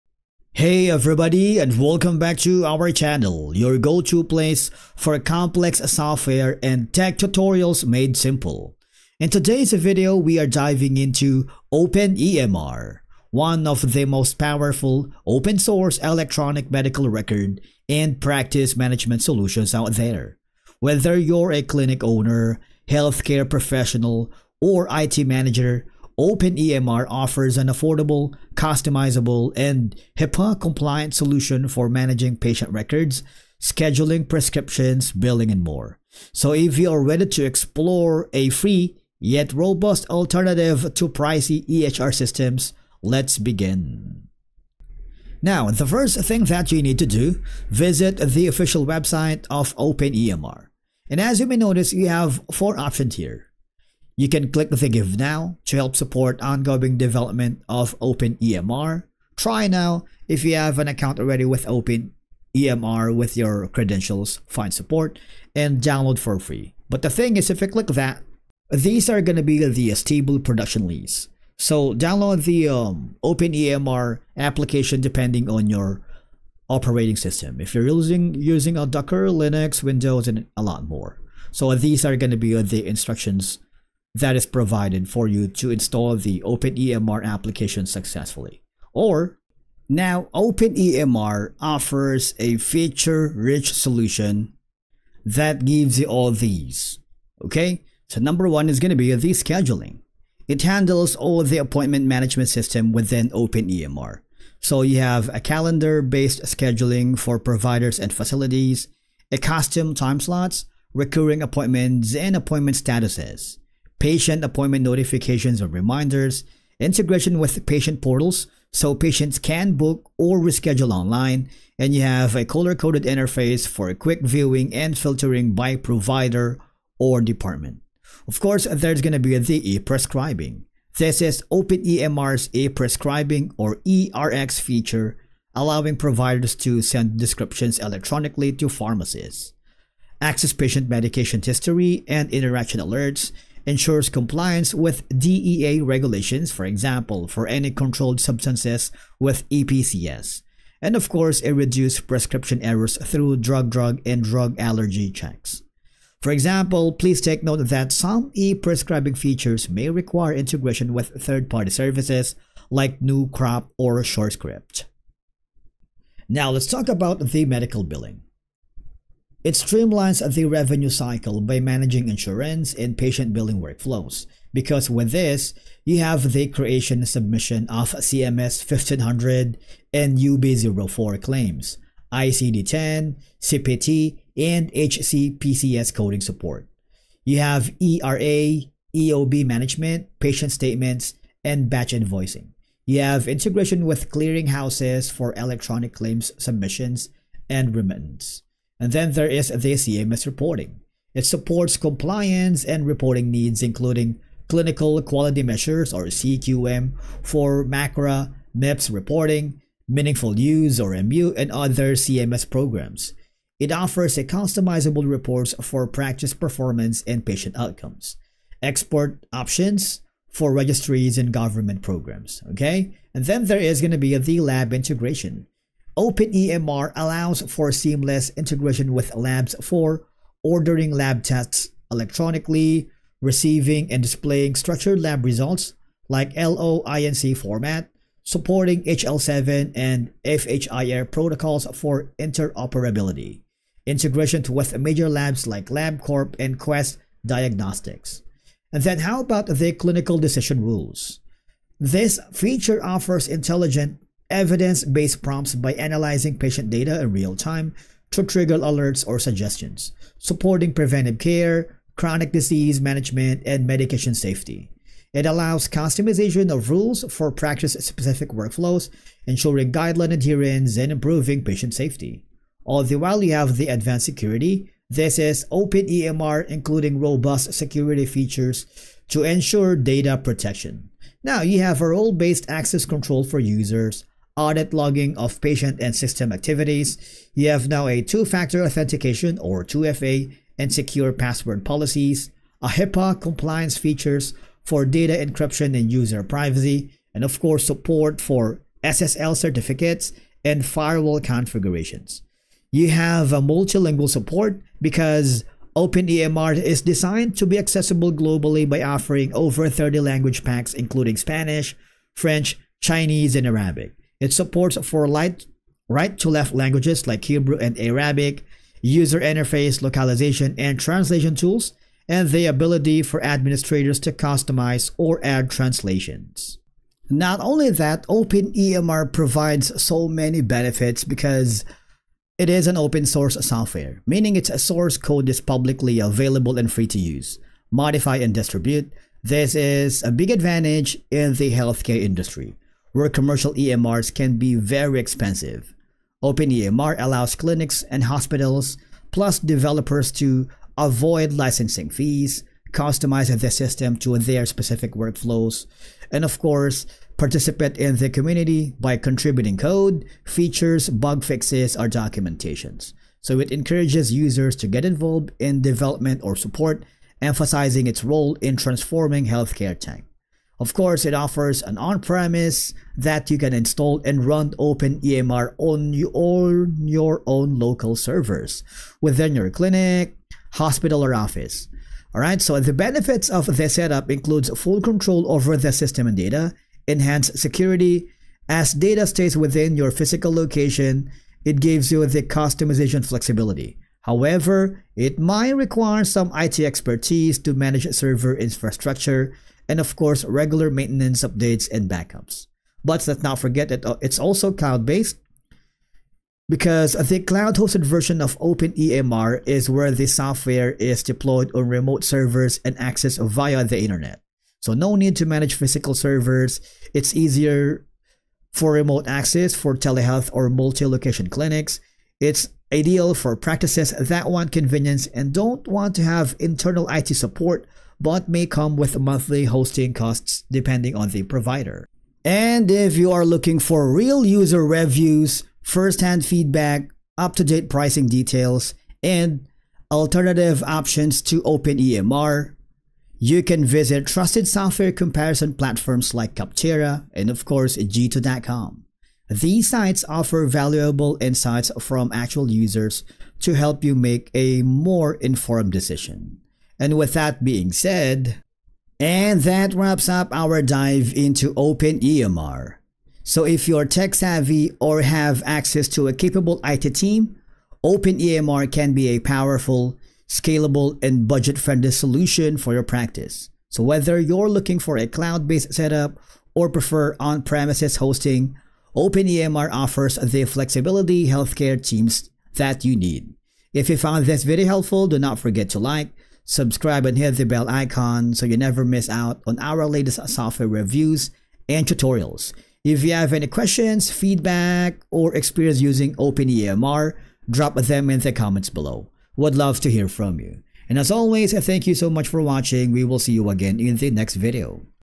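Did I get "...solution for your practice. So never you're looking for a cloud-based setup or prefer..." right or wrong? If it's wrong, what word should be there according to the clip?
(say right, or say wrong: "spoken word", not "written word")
wrong: "whether", not "never".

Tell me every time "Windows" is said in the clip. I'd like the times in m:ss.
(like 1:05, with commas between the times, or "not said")
1:19.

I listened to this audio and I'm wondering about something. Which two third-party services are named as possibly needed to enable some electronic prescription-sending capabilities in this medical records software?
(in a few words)
NewCrop or SureScript.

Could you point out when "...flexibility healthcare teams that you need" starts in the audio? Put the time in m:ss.
8:00.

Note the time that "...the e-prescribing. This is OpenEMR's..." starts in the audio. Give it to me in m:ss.
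2:09.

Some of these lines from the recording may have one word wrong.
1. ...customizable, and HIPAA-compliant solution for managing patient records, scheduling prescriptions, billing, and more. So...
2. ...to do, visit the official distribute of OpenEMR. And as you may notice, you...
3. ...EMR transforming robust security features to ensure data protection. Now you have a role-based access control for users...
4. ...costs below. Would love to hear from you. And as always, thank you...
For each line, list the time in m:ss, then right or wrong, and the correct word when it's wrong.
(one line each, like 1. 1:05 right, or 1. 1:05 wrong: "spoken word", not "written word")
1. 0:28 right
2. 0:46 wrong: "website", not "distribute"
3. 4:35 wrong: "including", not "transforming"
4. 8:18 wrong: "comments", not "costs".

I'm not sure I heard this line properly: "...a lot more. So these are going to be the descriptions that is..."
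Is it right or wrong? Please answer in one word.
wrong.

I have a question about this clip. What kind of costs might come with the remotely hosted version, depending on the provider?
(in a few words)
monthly hosting costs.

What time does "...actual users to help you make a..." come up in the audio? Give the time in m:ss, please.
7:32.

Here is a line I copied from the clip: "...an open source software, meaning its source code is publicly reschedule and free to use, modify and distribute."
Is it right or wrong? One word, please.
wrong.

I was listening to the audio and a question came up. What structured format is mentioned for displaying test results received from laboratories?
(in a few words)
LOINC.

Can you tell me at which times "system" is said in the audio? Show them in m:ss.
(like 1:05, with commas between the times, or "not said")
0:42, 1:17, 1:42, 4:45, 5:53, 6:25.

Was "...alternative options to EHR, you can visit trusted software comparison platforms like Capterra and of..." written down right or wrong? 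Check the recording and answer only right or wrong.
wrong.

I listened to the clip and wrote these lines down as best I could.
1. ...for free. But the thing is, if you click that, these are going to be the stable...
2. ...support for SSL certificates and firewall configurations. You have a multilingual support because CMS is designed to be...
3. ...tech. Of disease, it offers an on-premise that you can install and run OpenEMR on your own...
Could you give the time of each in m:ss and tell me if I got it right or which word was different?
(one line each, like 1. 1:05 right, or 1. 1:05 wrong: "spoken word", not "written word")
1. 1:06 right
2. 4:57 wrong: "OpenEMR", not "CMS"
3. 6:09 wrong: "course", not "disease".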